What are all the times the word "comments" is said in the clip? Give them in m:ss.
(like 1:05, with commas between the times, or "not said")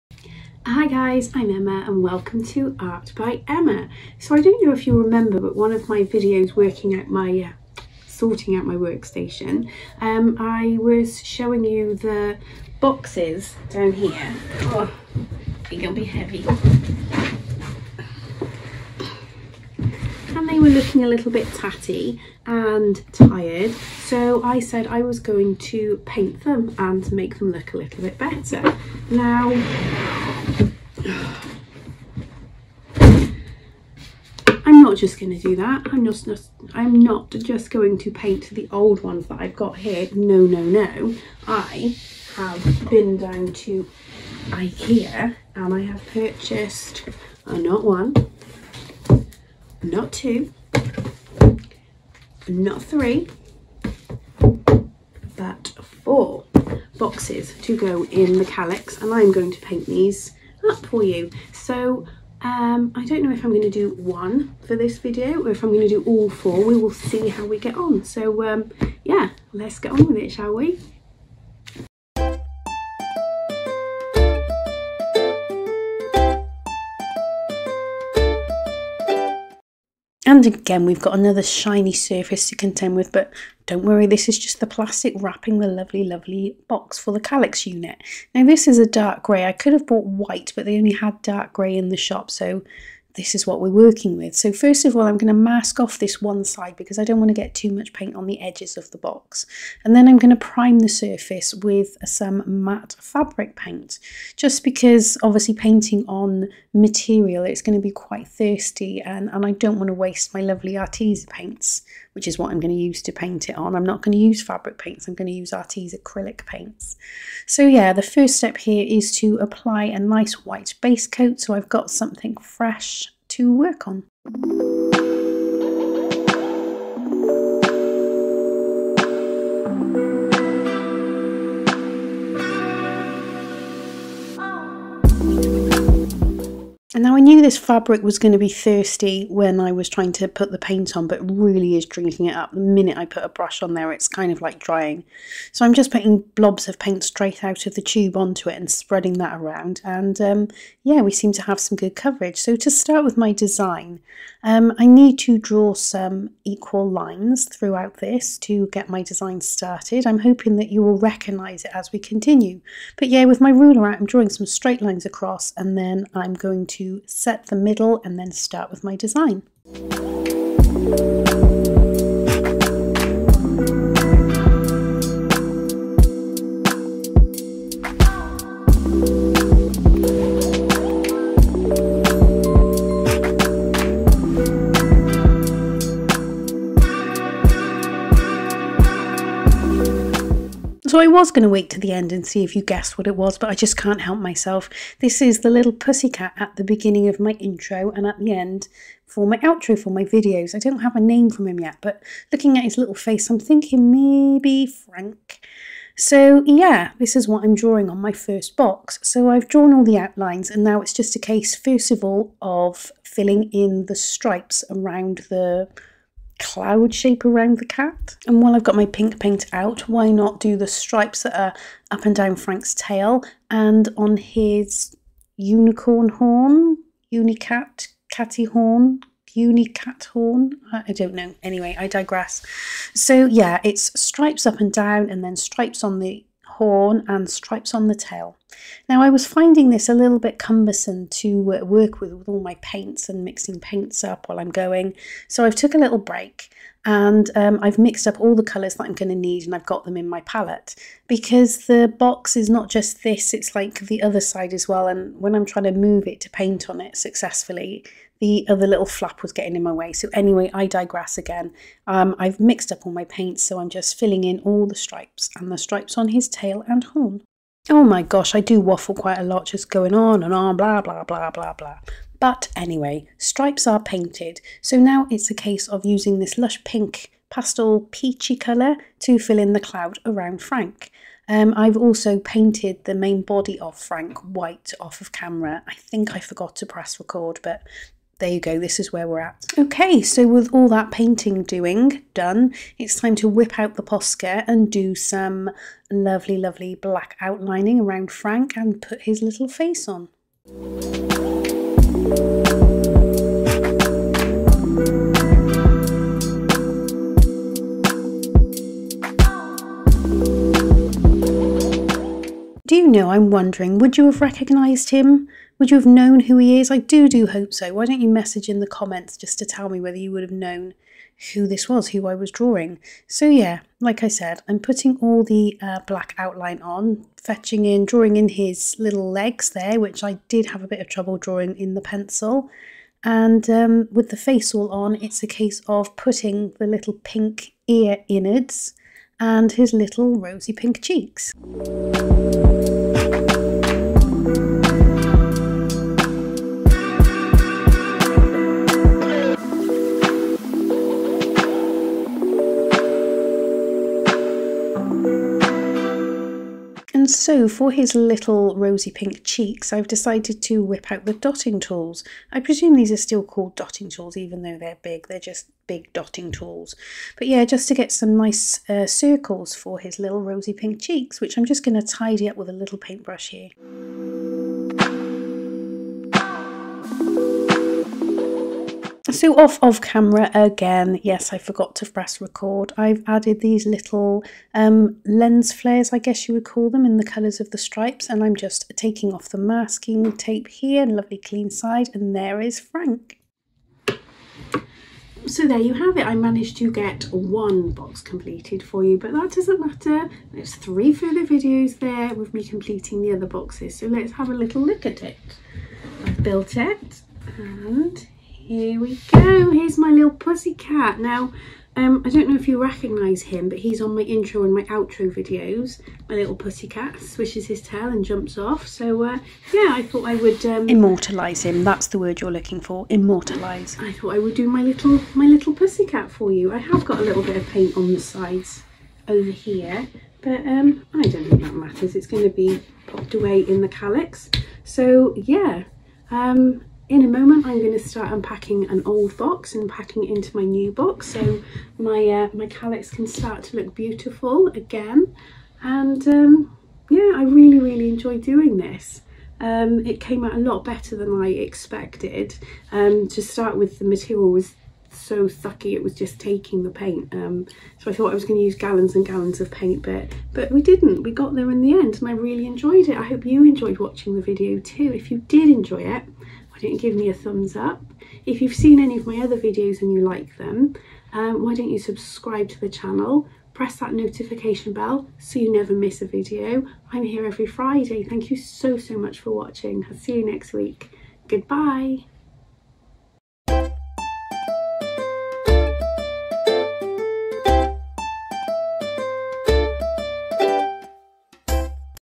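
5:18.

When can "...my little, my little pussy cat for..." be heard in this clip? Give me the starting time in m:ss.
7:04.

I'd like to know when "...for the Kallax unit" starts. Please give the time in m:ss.
1:26.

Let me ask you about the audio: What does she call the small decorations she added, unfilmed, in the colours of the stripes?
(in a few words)
Lens flares.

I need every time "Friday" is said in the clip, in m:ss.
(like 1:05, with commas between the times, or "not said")
7:57.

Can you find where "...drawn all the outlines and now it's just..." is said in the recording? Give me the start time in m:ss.
3:29.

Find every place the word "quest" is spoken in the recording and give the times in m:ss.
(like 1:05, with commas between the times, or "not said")
not said.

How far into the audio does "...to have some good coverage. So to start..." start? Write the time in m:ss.
2:31.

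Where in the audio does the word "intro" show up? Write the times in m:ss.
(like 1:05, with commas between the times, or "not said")
3:17, 6:54.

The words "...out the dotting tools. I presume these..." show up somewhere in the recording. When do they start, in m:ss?
6:00.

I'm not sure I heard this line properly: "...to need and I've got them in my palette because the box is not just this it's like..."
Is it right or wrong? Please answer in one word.
right.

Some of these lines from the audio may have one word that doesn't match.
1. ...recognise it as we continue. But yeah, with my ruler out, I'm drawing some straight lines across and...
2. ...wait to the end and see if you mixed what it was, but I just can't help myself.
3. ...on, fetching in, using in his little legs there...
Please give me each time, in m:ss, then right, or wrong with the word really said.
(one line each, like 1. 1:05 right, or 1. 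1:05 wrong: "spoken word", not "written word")
1. 2:40 right
2. 3:11 wrong: "guessed", not "mixed"
3. 5:26 wrong: "drawing", not "using".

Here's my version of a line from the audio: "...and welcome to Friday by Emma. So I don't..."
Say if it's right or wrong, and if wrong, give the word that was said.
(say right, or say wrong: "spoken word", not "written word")
wrong: "Art", not "Friday".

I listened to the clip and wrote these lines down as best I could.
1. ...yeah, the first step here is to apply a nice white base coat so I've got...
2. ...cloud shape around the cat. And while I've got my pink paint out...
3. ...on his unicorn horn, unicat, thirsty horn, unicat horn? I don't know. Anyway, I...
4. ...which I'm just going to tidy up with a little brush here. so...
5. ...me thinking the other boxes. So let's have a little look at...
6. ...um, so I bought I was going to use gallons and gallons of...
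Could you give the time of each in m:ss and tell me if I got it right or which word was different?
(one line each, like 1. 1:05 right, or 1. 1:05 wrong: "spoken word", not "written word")
1. 1:57 right
2. 3:36 right
3. 3:43 wrong: "catty", not "thirsty"
4. 6:11 wrong: "paintbrush", not "brush"
5. 6:42 wrong: "completing", not "thinking"
6. 7:37 wrong: "thought", not "bought".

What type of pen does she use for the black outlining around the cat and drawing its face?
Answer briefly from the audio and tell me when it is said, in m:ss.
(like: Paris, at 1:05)
Posca, at 4:53.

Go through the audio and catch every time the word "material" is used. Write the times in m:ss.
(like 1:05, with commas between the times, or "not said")
1:46, 7:33.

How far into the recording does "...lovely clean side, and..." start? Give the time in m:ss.
6:30.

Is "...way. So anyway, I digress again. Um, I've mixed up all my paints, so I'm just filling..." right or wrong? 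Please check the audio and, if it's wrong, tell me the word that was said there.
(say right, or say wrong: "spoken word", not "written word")
right.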